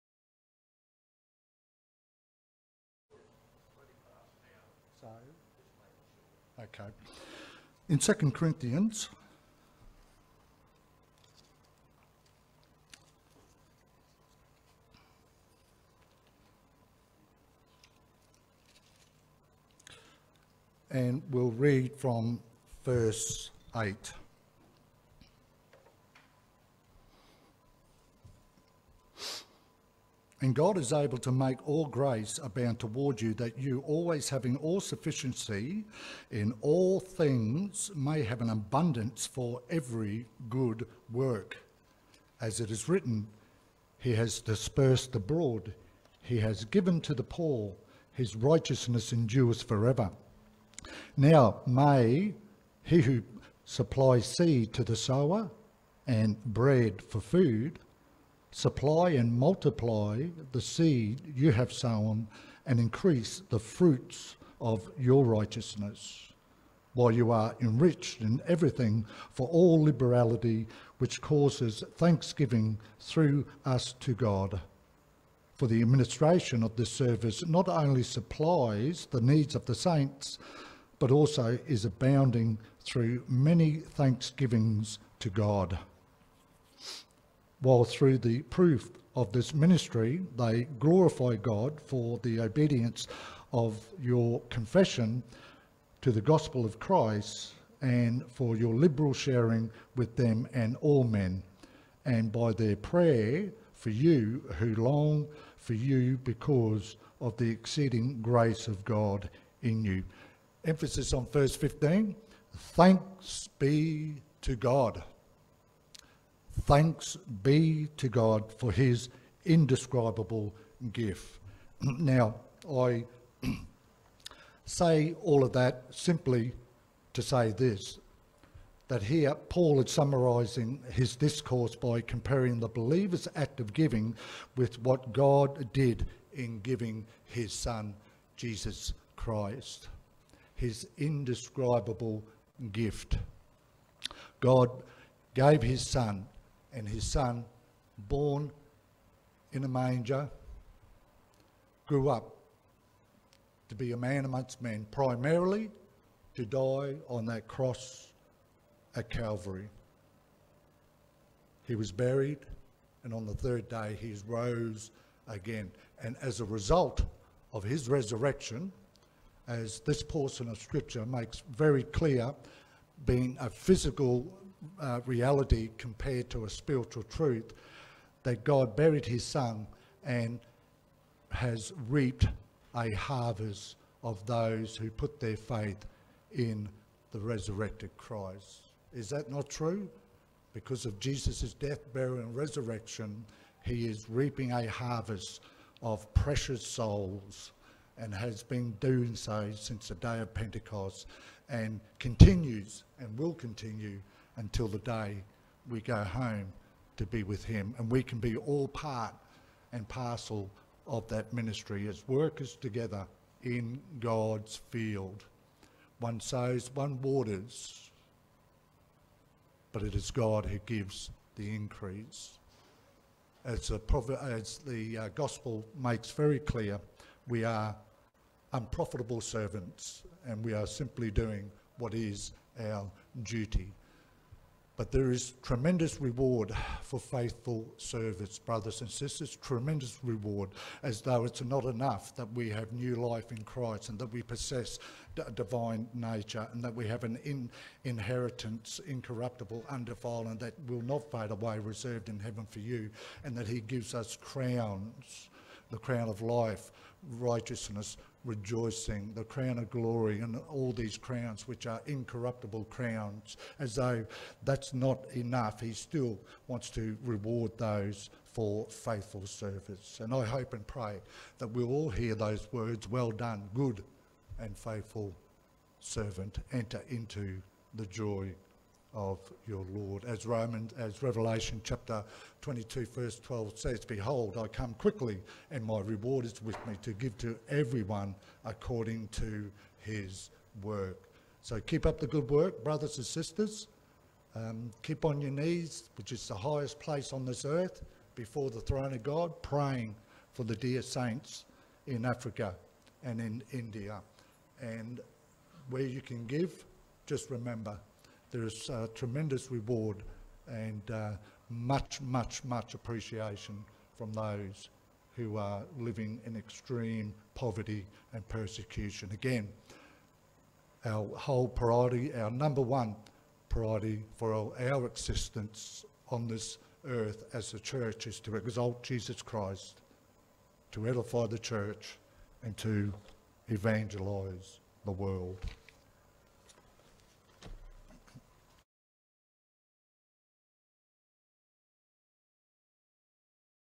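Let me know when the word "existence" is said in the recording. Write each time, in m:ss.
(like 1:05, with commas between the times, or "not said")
5:24.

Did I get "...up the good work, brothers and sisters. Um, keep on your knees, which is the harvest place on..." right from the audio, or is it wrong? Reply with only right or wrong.
wrong.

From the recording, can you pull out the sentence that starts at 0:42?
As it is written, He has dispersed abroad, He has given to the poor, His righteousness endures forever.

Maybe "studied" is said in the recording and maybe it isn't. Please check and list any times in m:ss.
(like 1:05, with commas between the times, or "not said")
not said.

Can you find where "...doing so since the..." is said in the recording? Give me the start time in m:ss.
3:18.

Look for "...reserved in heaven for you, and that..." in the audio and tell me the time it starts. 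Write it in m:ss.
4:11.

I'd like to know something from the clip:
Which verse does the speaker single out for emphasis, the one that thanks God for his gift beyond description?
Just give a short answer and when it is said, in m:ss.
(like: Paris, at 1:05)
Verse 15, at 1:51.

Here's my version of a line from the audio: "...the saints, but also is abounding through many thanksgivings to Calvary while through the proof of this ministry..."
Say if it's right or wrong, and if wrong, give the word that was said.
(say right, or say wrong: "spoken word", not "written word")
wrong: "God", not "Calvary".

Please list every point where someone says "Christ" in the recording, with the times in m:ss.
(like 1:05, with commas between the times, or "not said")
1:36, 2:19, 3:07, 4:03, 5:29.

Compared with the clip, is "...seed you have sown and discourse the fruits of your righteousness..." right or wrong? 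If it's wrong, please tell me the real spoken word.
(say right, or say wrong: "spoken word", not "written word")
wrong: "increase", not "discourse".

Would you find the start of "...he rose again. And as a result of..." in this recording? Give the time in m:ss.
2:43.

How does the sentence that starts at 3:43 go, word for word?
As the, as the uh, gospel makes very clear, we are unprofitable servants and we are simply doing what is our duty.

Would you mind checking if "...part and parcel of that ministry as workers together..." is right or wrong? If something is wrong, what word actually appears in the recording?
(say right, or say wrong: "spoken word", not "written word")
right.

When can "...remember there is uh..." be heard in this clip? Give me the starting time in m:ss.
5:07.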